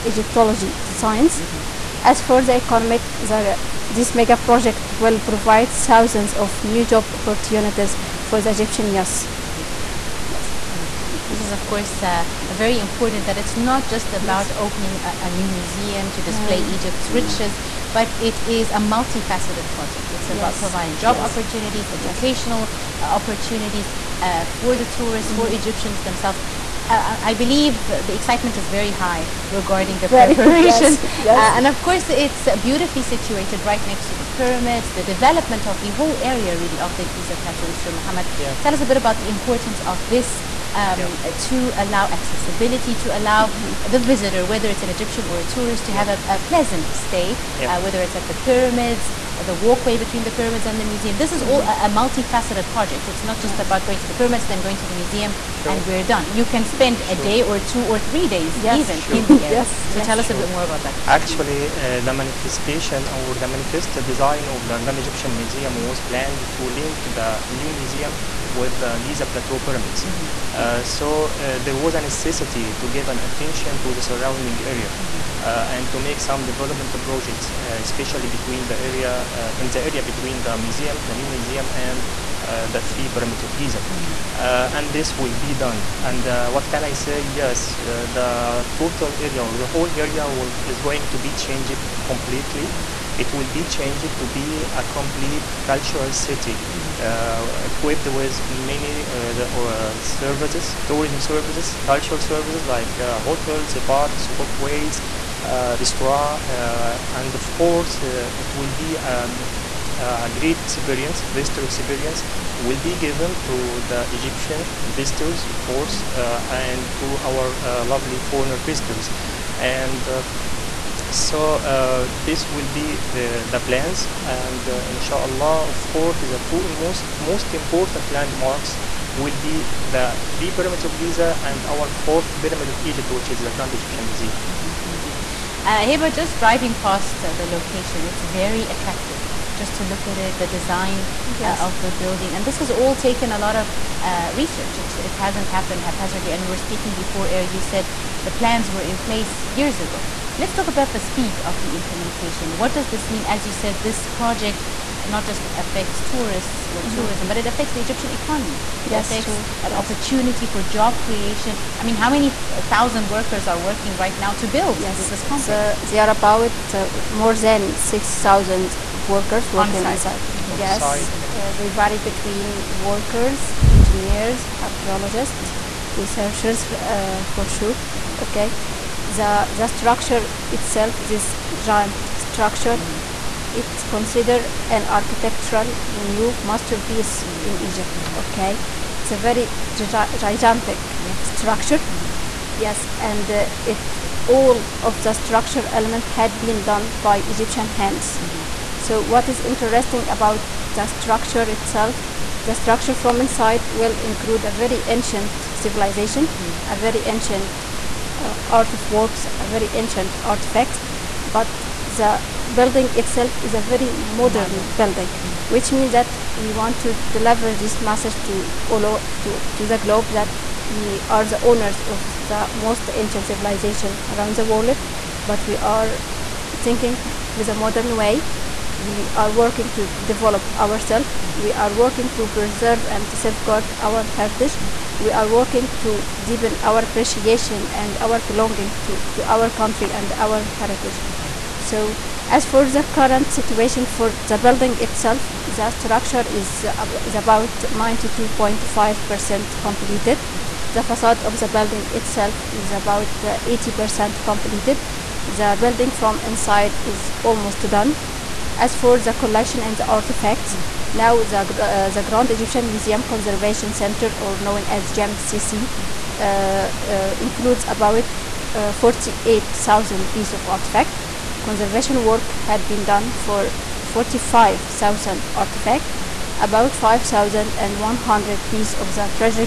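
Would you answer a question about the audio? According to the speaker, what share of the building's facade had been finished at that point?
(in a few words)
80%.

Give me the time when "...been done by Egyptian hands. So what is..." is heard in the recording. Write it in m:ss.
3:16.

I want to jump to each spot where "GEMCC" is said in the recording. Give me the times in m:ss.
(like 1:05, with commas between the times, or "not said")
4:24.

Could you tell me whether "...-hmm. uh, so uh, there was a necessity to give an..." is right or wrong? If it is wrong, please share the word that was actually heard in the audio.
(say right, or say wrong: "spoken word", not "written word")
right.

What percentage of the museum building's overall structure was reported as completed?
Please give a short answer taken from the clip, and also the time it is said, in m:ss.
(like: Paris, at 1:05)
92.5%, at 4:07.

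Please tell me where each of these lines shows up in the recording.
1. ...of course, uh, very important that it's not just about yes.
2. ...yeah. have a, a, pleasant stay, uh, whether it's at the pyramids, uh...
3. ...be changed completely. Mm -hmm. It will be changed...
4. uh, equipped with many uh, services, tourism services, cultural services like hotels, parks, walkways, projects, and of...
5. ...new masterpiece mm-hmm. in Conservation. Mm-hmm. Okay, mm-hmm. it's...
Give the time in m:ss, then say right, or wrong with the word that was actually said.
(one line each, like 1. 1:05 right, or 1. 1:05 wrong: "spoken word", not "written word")
1. 0:11 right
2. 0:45 right
3. 1:31 right
4. 1:37 wrong: "restaurants", not "projects"
5. 3:05 wrong: "Egypt", not "Conservation".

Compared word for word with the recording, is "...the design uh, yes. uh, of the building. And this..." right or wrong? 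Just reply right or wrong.
right.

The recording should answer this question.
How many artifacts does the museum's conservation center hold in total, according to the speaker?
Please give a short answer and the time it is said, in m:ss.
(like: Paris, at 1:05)
48,000, at 4:28.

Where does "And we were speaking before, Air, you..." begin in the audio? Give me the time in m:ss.
2:26.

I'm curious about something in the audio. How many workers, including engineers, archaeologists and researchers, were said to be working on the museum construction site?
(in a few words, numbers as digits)
more than 6,000.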